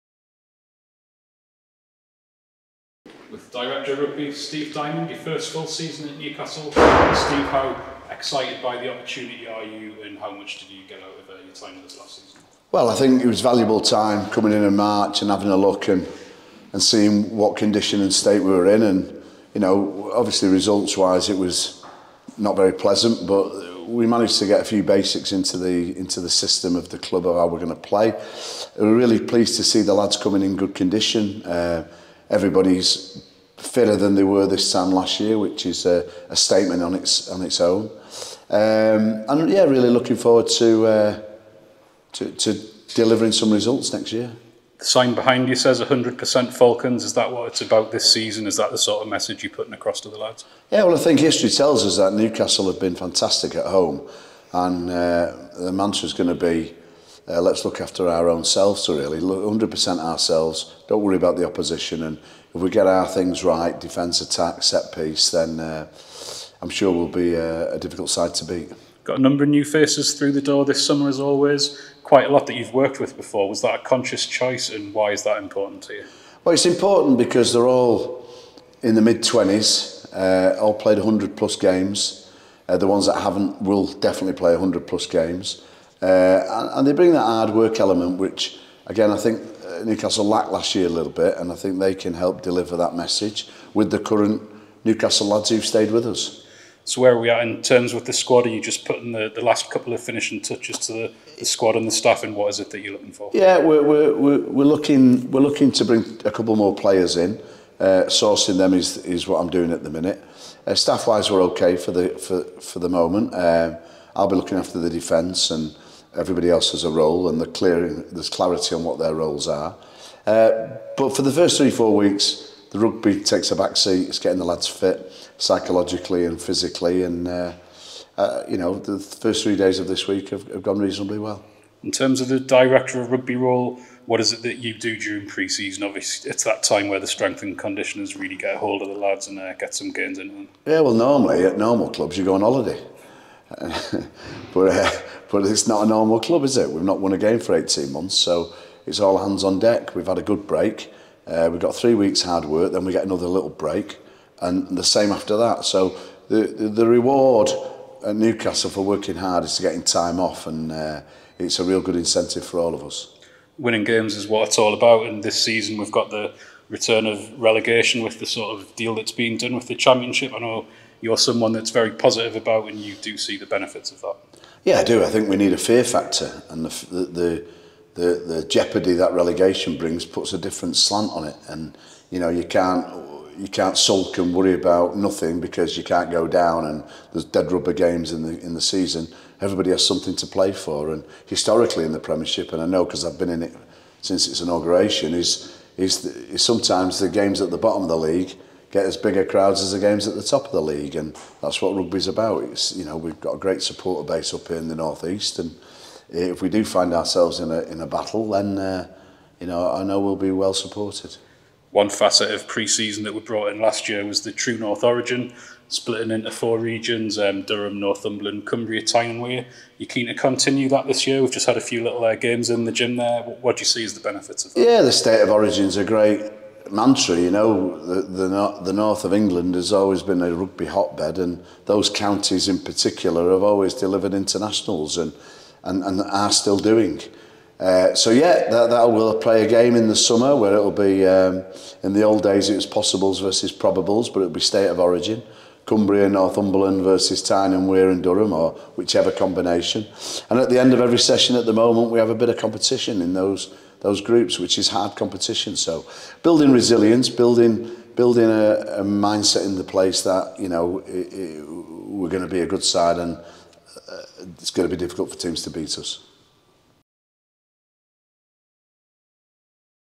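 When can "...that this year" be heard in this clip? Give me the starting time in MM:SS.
03:40.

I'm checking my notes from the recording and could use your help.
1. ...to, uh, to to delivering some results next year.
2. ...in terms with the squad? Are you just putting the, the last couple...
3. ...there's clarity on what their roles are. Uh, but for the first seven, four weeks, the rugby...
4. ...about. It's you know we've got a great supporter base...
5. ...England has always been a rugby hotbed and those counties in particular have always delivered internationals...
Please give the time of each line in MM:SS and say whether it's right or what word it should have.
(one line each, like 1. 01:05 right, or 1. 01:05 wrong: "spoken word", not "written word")
1. 00:40 right
2. 01:37 right
3. 01:57 wrong: "three", not "seven"
4. 03:22 right
5. 03:49 right.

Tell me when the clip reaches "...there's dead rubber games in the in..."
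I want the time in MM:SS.
03:07.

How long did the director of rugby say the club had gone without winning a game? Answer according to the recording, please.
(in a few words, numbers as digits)
18 months.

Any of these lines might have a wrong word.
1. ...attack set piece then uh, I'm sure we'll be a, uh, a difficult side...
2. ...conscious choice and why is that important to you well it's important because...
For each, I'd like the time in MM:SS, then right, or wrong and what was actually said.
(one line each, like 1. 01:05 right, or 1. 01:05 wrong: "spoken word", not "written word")
1. 01:04 right
2. 01:13 right.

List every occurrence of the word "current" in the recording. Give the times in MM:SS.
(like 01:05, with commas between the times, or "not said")
01:33.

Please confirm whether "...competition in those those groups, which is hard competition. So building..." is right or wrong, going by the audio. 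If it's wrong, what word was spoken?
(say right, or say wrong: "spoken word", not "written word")
right.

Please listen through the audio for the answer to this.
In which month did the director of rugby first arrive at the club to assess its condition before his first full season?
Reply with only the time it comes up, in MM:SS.
00:14.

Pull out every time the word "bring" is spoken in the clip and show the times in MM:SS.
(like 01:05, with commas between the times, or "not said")
01:26, 01:45, 02:59.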